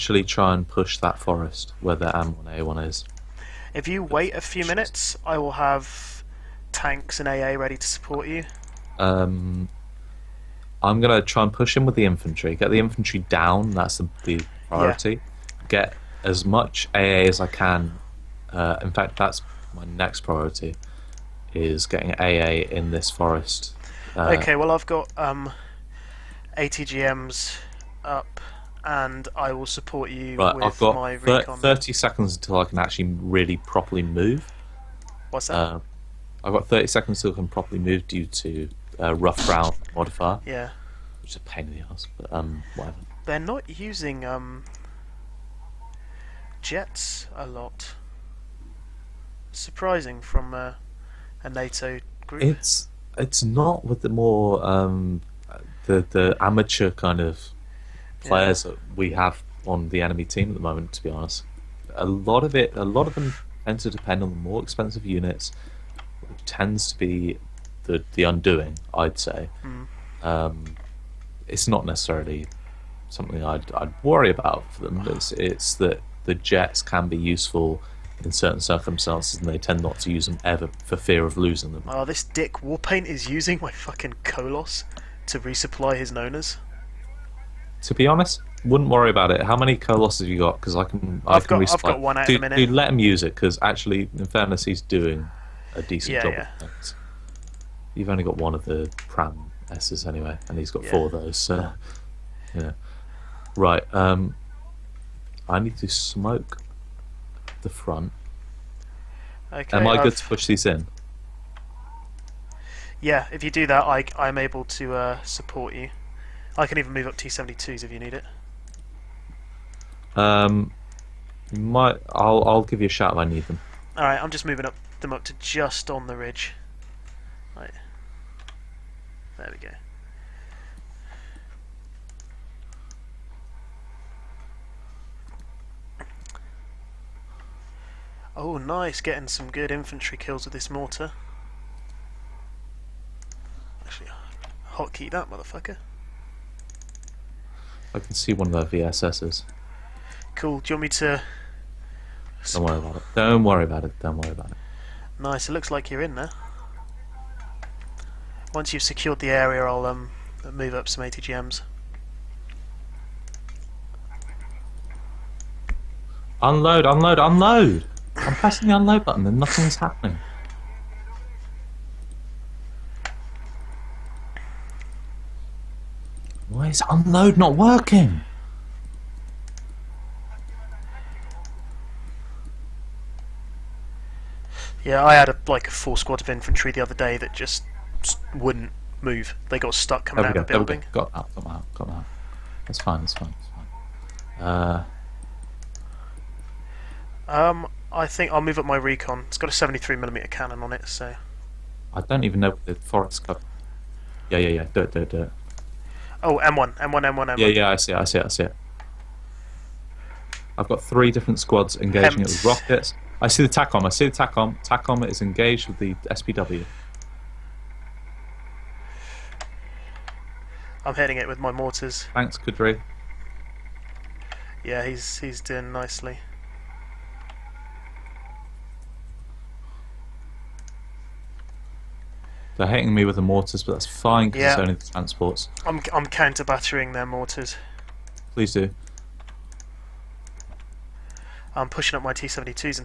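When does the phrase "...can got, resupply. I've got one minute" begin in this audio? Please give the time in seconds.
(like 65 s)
91 s.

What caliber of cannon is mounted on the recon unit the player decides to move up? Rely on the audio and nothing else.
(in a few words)
73mm.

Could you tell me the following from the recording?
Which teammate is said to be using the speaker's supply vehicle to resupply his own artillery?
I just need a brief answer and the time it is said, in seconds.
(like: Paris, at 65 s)
Warpaint, at 82 s.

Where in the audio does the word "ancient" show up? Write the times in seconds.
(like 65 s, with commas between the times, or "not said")
not said.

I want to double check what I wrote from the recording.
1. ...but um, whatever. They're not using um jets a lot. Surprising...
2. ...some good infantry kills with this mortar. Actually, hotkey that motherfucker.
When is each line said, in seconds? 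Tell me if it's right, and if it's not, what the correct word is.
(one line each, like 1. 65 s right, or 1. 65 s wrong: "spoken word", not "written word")
1. 42 s right
2. 139 s right.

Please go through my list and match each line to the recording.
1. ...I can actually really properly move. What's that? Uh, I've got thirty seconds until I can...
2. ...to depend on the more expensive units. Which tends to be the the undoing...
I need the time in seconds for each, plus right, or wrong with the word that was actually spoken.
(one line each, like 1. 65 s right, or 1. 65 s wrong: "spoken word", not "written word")
1. 32 s right
2. 63 s right.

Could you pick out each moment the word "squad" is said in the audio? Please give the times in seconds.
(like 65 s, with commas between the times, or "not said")
185 s, 211 s.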